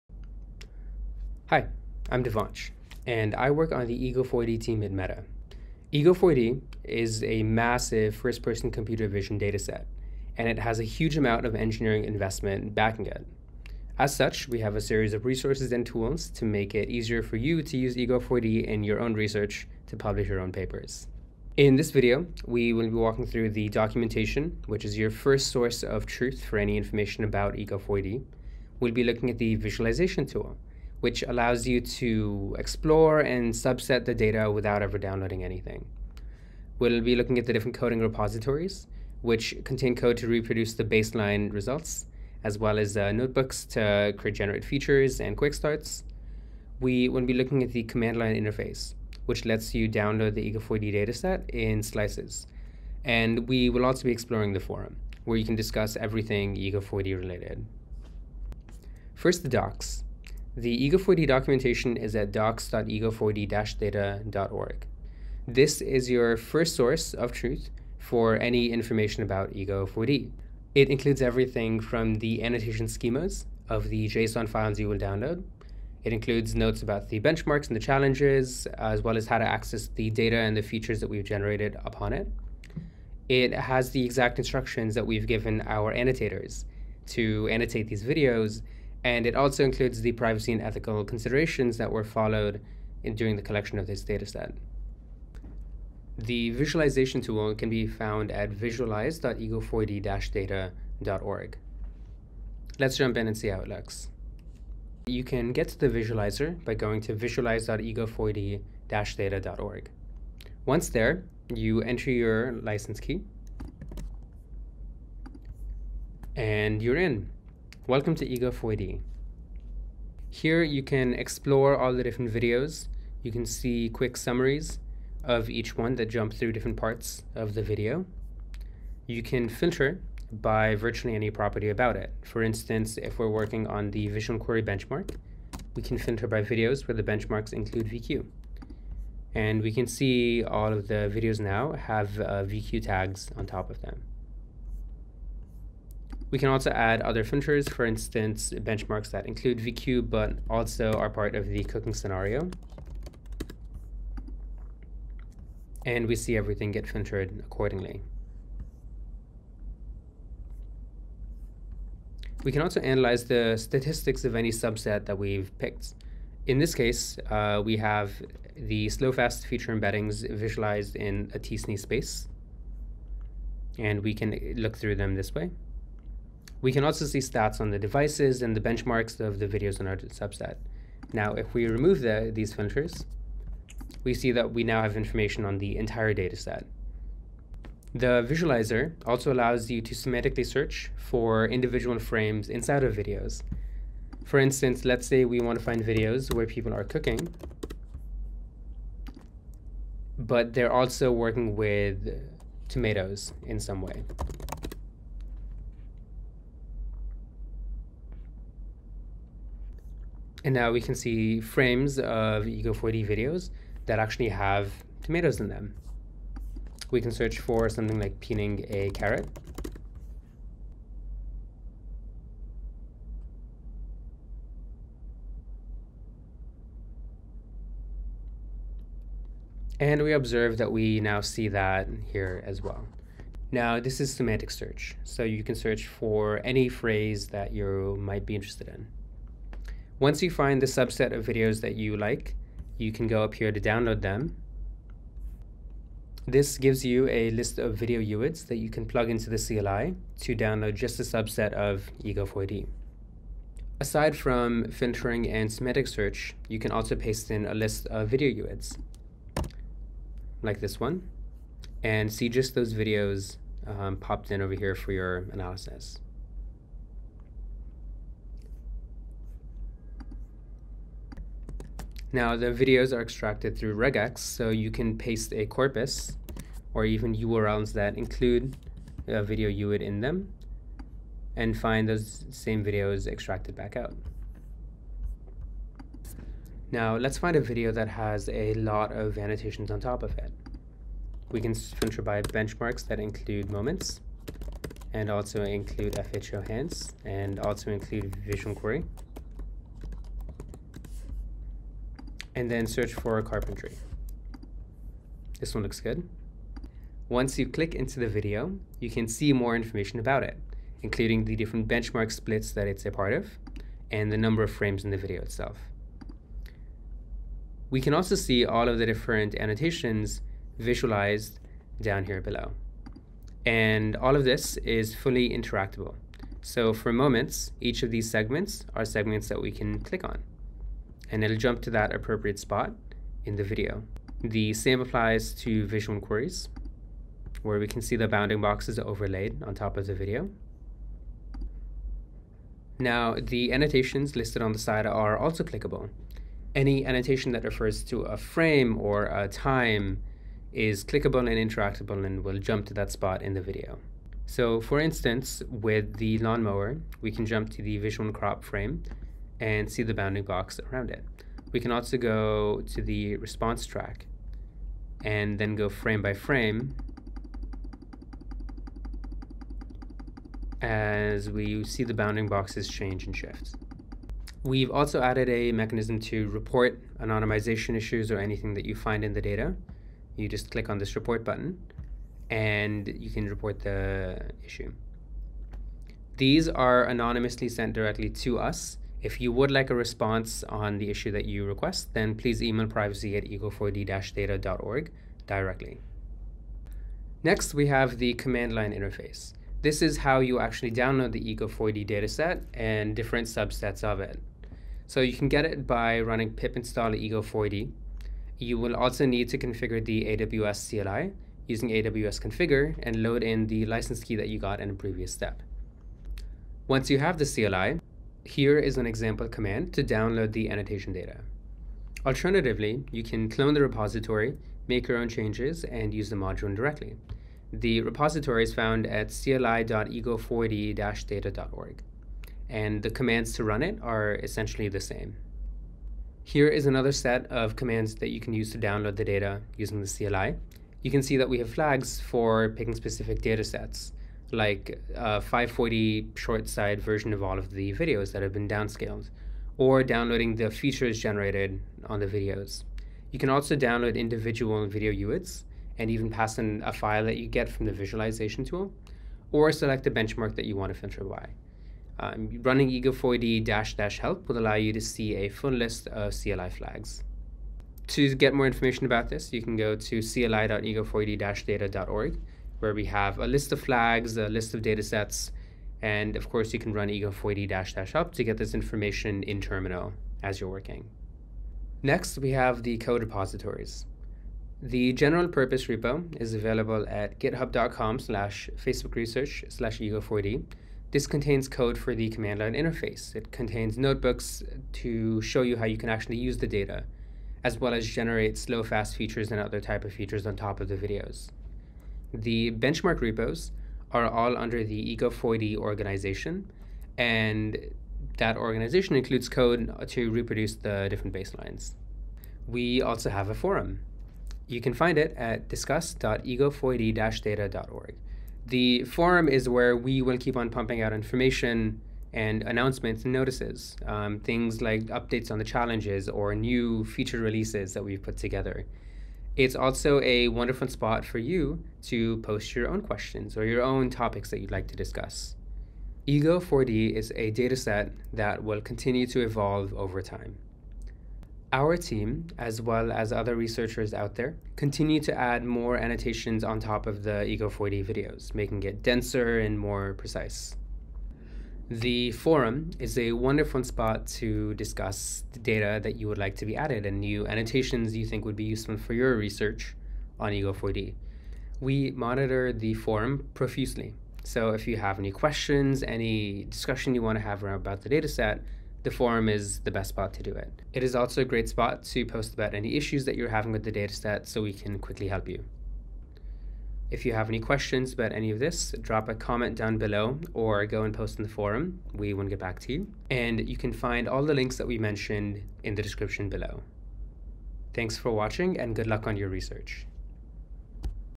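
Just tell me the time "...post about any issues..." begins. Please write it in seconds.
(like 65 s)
572 s.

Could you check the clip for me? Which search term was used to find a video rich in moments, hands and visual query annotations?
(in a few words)
carpentry.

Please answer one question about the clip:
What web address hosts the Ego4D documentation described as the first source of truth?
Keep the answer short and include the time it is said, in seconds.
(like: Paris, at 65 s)
docs.ego4d-data.org, at 62 s.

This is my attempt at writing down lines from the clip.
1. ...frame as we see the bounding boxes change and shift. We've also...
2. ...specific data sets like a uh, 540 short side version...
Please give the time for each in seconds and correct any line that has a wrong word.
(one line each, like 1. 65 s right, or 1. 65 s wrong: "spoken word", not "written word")
1. 366 s right
2. 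442 s right.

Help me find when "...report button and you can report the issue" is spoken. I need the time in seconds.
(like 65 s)
380 s.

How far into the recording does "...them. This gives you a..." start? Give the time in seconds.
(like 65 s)
244 s.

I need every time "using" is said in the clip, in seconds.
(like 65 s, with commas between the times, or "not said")
411 s, 439 s.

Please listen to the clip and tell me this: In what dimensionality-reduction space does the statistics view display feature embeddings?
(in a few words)
t-SNE.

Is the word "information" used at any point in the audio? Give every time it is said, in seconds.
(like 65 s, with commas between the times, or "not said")
26 s, 68 s, 184 s, 309 s, 468 s, 478 s, 520 s.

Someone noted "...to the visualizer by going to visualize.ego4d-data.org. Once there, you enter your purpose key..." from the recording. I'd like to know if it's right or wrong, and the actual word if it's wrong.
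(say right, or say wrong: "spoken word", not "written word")
wrong: "license", not "purpose".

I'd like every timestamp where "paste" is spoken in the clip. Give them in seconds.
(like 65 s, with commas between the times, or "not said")
256 s, 274 s.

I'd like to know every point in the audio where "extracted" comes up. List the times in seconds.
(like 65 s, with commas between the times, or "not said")
273 s, 283 s.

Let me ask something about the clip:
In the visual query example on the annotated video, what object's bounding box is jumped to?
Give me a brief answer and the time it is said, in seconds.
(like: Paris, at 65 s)
lawnmower, at 356 s.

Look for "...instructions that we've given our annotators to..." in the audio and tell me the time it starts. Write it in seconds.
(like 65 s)
84 s.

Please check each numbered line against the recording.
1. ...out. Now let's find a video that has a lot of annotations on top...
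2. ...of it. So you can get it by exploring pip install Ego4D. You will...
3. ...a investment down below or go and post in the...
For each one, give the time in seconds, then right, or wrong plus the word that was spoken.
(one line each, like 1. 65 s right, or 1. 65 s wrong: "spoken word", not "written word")
1. 283 s right
2. 403 s wrong: "running", not "exploring"
3. 579 s wrong: "comment", not "investment".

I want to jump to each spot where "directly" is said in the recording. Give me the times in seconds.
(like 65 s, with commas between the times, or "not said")
387 s, 395 s, 426 s.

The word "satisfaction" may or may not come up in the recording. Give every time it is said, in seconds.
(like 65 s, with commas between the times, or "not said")
not said.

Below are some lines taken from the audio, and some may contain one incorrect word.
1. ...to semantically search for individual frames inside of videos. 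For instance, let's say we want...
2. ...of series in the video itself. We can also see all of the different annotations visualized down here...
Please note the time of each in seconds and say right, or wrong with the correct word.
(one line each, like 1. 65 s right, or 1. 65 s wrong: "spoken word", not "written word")
1. 189 s right
2. 314 s wrong: "frames", not "series".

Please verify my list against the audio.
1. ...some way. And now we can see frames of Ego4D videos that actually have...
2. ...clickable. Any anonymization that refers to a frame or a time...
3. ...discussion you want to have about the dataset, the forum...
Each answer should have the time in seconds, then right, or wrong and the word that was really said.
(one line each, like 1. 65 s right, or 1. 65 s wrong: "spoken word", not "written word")
1. 203 s right
2. 345 s wrong: "annotation", not "anonymization"
3. 566 s right.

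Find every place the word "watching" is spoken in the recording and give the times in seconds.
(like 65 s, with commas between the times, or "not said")
588 s.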